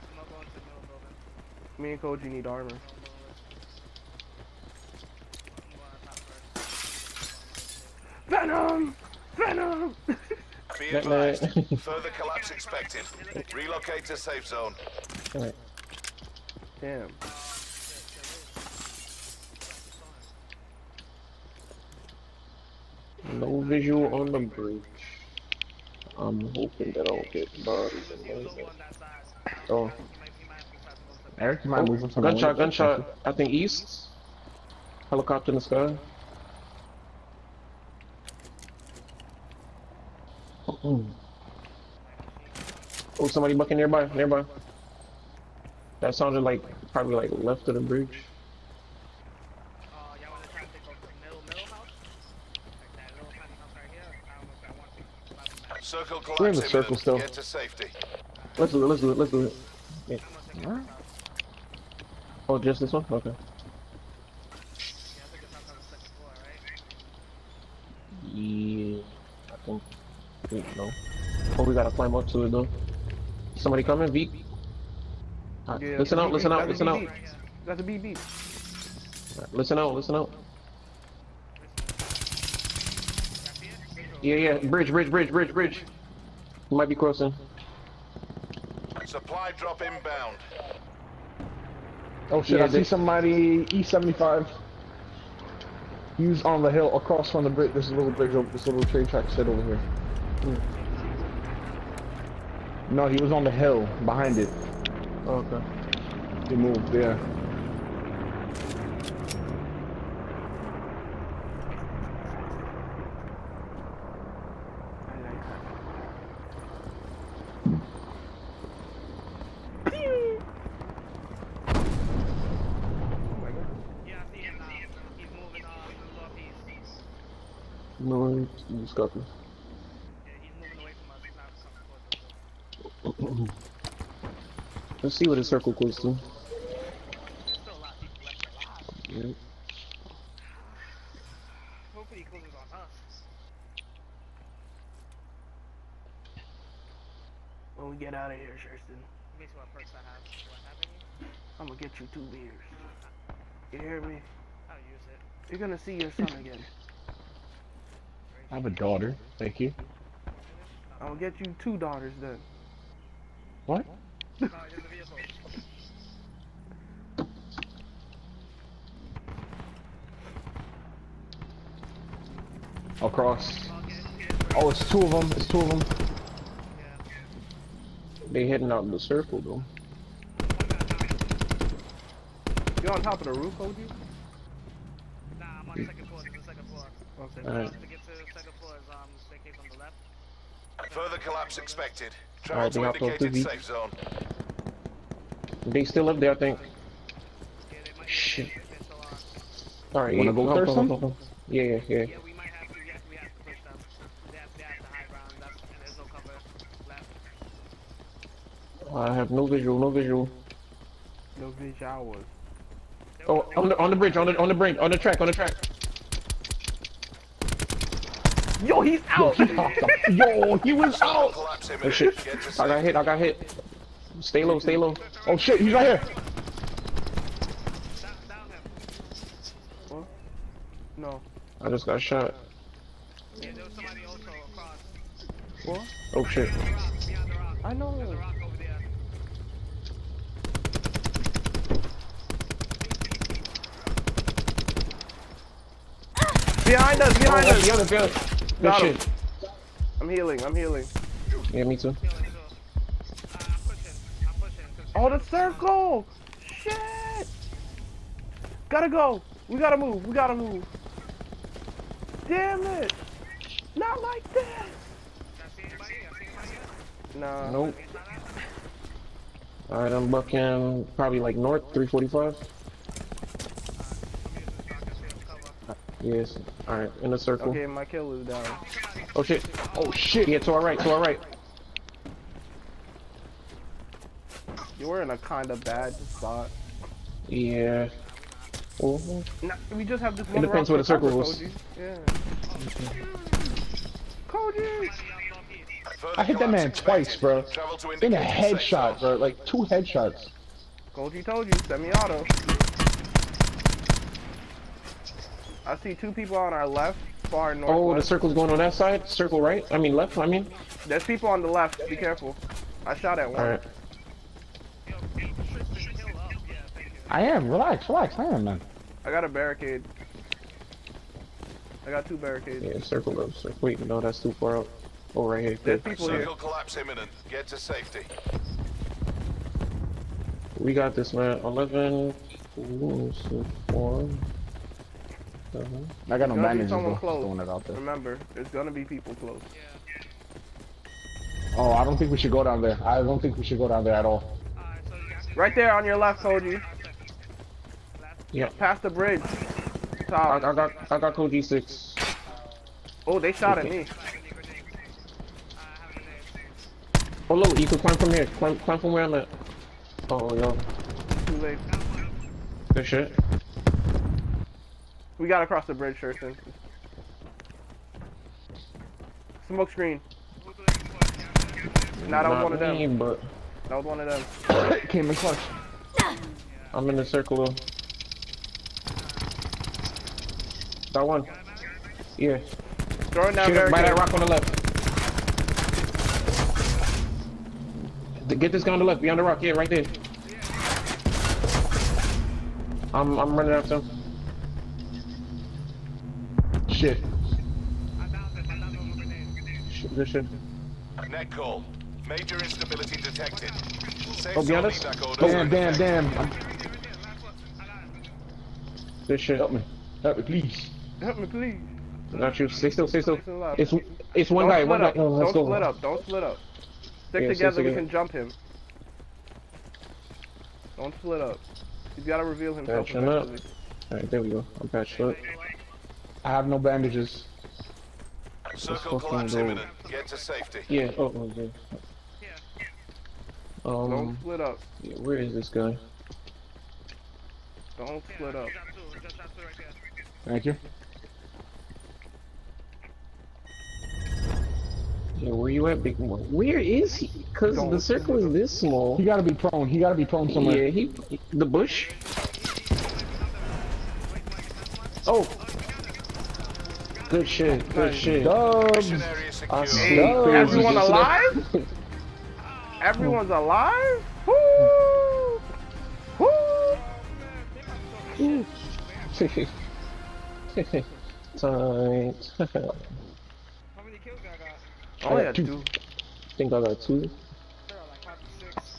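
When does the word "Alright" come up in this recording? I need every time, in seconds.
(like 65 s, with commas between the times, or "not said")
269 s, 276 s, 423 s.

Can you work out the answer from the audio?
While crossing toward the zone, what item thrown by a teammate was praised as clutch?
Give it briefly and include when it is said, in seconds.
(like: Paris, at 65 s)
Smoke screen, at 369 s.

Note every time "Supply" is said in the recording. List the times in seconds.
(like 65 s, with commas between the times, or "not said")
89 s.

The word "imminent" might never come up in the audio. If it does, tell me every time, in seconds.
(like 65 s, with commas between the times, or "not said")
326 s, 429 s.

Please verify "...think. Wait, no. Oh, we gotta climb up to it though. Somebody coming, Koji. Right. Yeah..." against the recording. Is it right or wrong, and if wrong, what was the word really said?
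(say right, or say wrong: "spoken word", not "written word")
wrong: "Beep", not "Koji".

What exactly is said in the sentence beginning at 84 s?
Yeah, yeah, bridge, bridge, bridge, bridge, bridge.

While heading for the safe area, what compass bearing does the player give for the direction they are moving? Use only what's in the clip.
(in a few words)
345.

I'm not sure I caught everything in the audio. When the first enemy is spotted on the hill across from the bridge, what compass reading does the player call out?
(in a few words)
E75.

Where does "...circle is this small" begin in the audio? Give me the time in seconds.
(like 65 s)
447 s.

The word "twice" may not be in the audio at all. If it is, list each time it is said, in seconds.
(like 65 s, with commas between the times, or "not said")
296 s.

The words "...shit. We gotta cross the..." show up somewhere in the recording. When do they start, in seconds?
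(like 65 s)
362 s.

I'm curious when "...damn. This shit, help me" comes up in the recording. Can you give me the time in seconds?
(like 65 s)
405 s.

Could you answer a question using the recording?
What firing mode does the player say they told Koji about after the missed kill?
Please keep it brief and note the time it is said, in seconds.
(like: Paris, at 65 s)
Semi-auto, at 301 s.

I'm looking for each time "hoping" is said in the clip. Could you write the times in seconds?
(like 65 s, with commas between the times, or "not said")
26 s.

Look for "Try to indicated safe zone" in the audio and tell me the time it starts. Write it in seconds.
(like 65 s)
192 s.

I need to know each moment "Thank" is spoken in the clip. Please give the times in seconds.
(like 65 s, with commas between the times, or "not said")
159 s, 440 s.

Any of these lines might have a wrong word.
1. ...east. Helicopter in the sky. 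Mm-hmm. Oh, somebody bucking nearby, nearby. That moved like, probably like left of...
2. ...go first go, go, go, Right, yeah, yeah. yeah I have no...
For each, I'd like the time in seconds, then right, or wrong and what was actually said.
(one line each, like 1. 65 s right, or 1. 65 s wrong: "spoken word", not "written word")
1. 33 s wrong: "sounded", not "moved"
2. 200 s wrong: "Yeah", not "Right".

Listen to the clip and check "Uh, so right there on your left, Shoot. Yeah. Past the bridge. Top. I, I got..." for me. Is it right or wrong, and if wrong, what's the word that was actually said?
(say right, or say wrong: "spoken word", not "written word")
wrong: "Koji", not "Shoot".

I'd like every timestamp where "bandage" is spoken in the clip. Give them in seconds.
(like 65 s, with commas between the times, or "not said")
336 s, 426 s.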